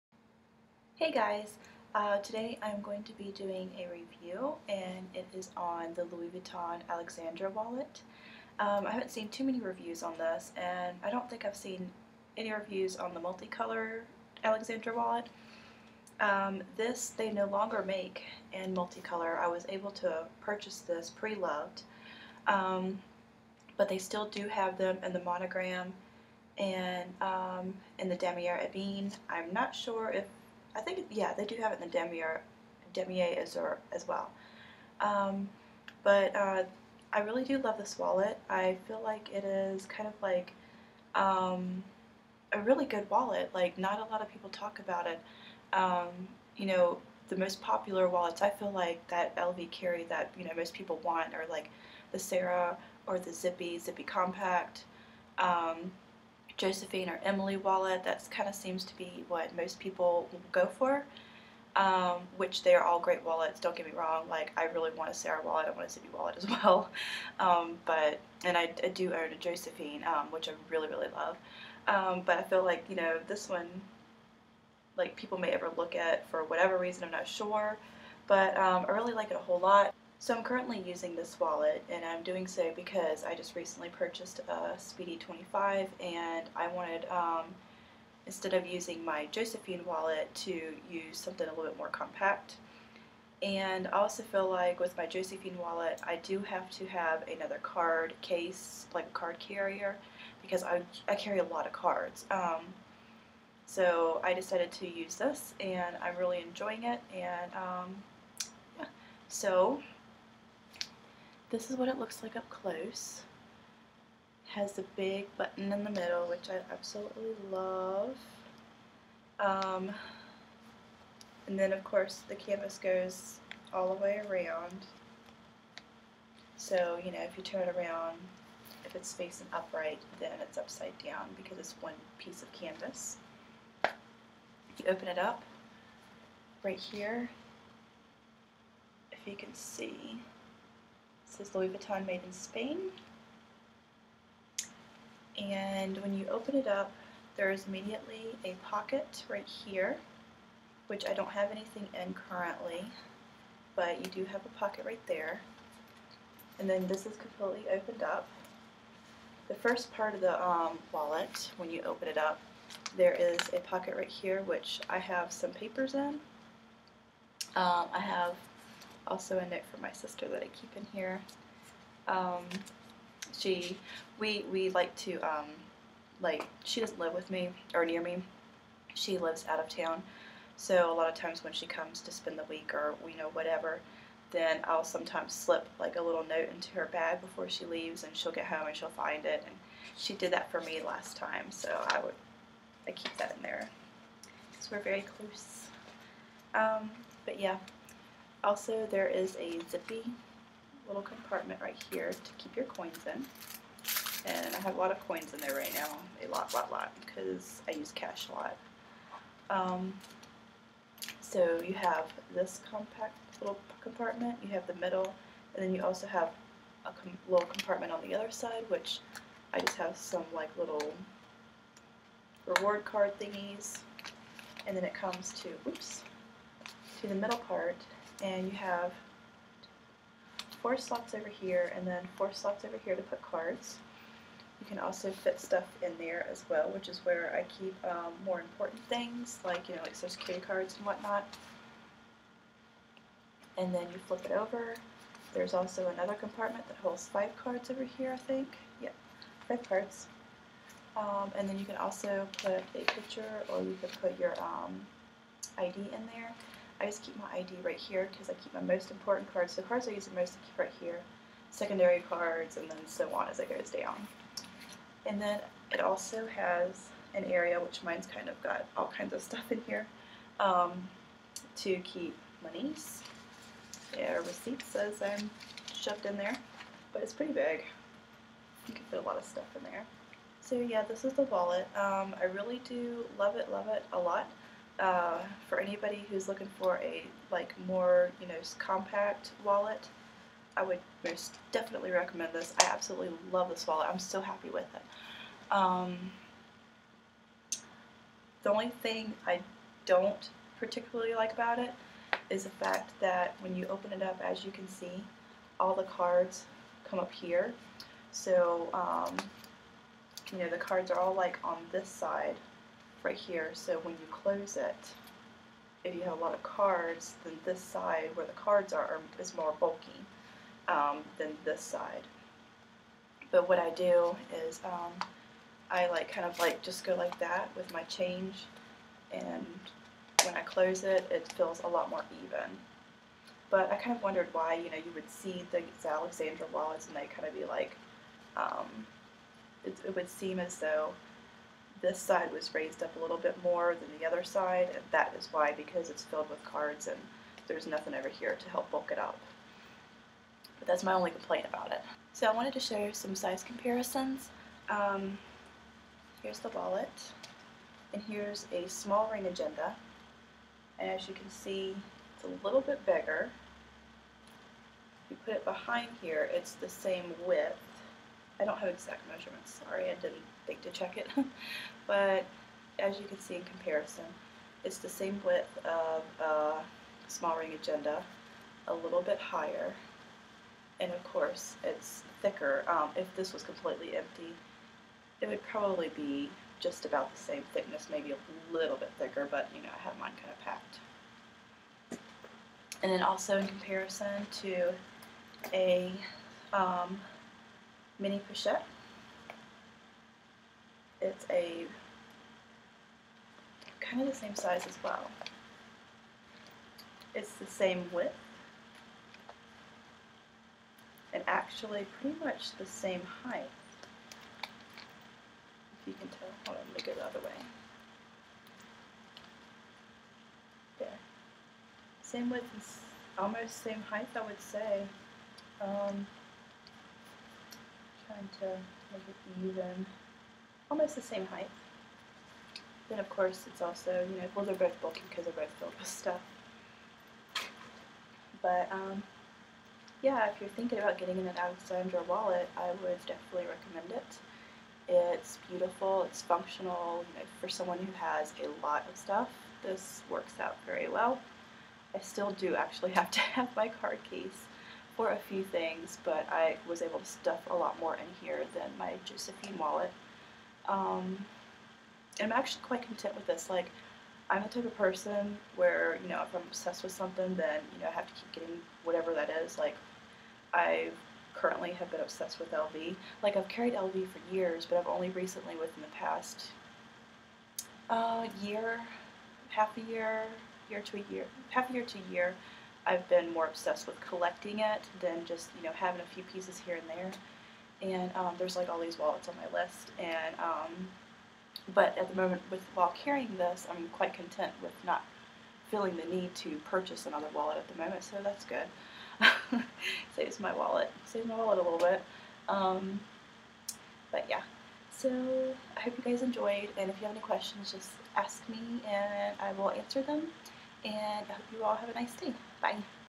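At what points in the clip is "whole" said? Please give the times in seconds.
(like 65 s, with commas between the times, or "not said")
79 s.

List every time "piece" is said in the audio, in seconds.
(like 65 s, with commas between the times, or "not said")
132 s, 486 s.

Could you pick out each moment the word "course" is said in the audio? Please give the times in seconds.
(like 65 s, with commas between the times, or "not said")
121 s, 381 s, 433 s.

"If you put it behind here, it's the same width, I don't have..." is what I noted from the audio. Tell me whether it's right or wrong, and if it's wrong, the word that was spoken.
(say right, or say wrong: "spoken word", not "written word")
right.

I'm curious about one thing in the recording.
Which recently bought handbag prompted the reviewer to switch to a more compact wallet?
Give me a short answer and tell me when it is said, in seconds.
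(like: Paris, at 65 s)
Speedy 25, at 84 s.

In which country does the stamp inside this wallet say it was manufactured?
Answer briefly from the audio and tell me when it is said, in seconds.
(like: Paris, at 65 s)
Spain, at 142 s.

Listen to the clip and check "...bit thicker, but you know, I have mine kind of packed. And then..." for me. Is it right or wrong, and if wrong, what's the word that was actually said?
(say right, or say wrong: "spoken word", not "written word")
right.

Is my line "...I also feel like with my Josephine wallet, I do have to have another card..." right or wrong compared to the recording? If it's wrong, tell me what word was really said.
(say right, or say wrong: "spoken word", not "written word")
right.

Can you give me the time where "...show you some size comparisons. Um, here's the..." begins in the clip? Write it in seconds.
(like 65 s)
352 s.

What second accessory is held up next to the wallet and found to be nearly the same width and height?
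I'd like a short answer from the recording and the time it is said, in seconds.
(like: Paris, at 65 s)
mini pochette, at 398 s.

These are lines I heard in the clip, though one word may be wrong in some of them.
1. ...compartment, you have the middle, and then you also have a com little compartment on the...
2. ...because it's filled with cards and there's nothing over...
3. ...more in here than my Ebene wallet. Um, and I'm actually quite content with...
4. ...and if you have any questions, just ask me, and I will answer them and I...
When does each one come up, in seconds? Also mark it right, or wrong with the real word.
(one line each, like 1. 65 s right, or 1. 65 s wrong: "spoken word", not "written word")
1. 213 s right
2. 345 s right
3. 457 s wrong: "Josephine", not "Ebene"
4. 506 s right.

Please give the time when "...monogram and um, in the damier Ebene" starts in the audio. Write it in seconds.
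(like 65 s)
25 s.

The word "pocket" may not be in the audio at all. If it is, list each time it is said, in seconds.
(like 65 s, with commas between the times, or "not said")
148 s, 154 s, 163 s.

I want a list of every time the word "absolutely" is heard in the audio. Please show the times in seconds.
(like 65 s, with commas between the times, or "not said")
116 s, 292 s.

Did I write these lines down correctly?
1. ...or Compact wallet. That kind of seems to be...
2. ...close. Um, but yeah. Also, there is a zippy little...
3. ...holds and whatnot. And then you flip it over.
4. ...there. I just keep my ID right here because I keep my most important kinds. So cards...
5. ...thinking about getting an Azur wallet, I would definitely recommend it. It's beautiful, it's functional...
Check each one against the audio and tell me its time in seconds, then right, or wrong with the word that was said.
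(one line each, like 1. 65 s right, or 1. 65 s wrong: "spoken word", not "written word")
1. 57 s wrong: "Emily", not "Compact"
2. 195 s right
3. 240 s wrong: "cards", not "holds"
4. 256 s wrong: "cards", not "kinds"
5. 440 s wrong: "Alexandra", not "Azur".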